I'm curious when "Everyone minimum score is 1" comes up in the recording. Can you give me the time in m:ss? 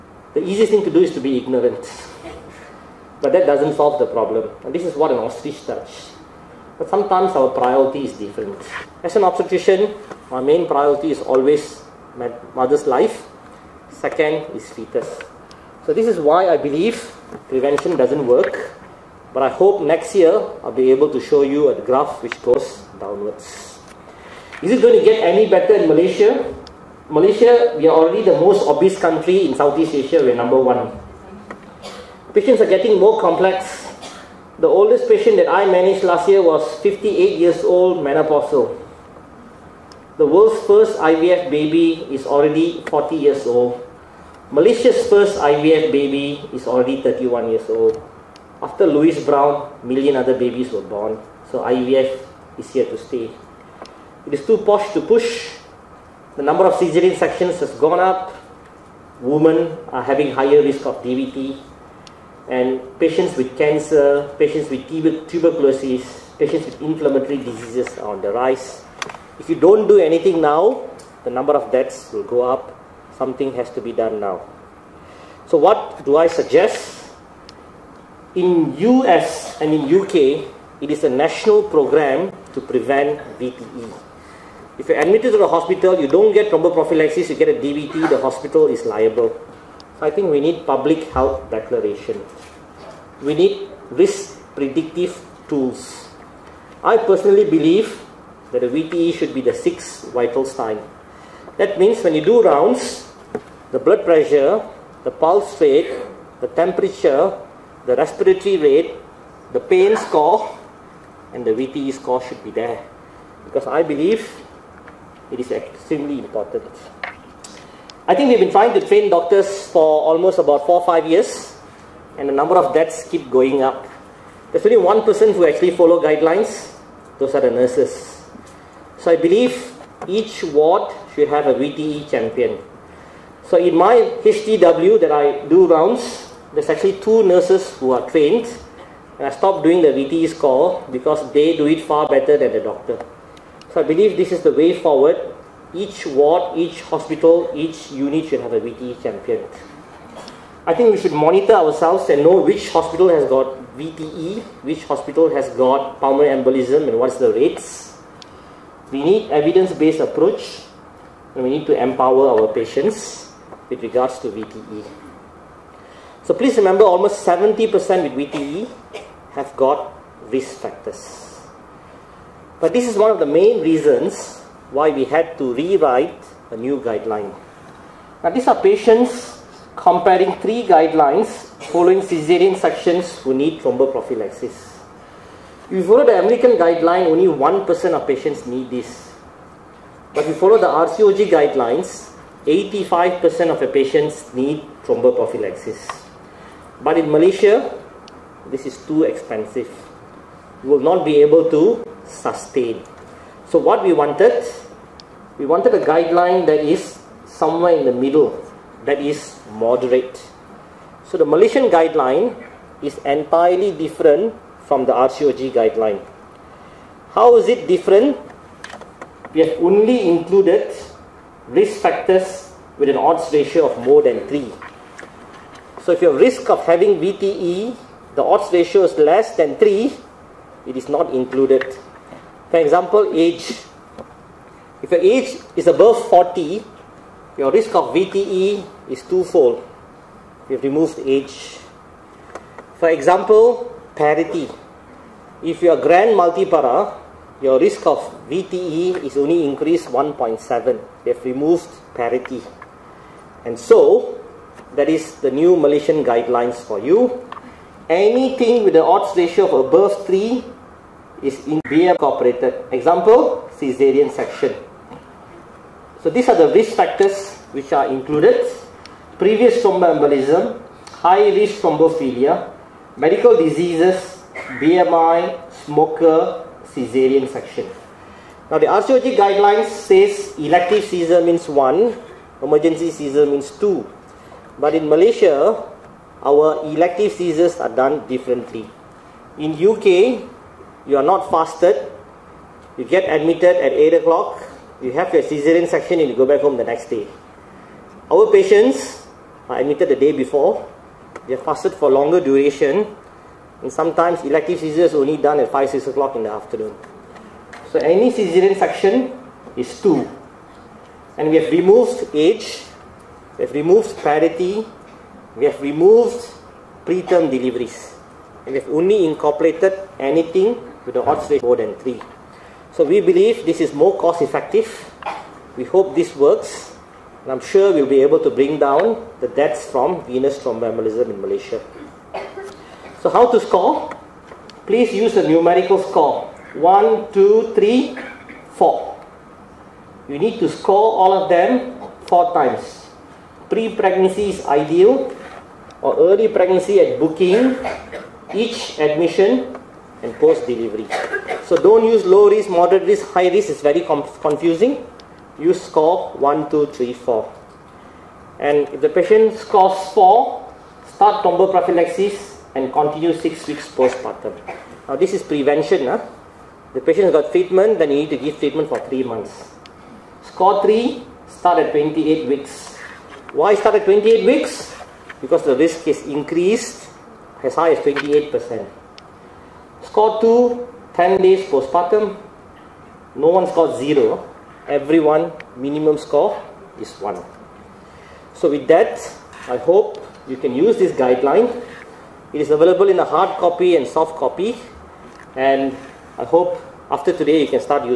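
6:24.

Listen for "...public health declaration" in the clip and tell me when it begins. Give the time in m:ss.
1:30.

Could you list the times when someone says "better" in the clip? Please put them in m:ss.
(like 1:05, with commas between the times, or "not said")
0:25, 2:22.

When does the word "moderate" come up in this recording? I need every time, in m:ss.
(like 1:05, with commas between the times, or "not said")
3:29, 5:52.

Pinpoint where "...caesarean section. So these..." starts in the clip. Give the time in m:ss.
4:23.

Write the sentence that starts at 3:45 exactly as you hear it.
So if your risk of having VTE, the odds ratio is less than 3, it is not included.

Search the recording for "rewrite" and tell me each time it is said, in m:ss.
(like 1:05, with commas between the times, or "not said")
2:55.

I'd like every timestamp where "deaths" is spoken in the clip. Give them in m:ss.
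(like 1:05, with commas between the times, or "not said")
1:11, 2:02, 5:29.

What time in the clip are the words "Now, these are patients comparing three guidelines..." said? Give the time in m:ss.
2:58.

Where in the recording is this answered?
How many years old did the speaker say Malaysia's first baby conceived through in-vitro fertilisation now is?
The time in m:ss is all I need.
0:47.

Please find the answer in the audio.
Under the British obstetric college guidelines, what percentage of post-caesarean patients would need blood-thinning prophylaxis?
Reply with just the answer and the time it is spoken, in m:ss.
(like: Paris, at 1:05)
85%, at 3:12.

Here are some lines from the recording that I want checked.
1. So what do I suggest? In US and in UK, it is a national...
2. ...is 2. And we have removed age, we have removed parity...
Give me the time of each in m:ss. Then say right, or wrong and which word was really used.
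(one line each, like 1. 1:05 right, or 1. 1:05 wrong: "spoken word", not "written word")
1. 1:15 right
2. 5:09 right.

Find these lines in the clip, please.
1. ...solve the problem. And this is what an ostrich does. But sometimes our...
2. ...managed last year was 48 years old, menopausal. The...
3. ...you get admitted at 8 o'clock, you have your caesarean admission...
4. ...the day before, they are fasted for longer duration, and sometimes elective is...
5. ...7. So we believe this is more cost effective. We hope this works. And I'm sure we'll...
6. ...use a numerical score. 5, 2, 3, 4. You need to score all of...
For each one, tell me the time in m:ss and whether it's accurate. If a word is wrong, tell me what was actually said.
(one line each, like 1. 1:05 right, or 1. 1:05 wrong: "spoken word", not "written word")
1. 0:03 right
2. 0:35 wrong: "58", not "48"
3. 4:52 wrong: "section", not "admission"
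4. 4:59 right
5. 5:21 wrong: "3", not "7"
6. 5:34 wrong: "1", not "5".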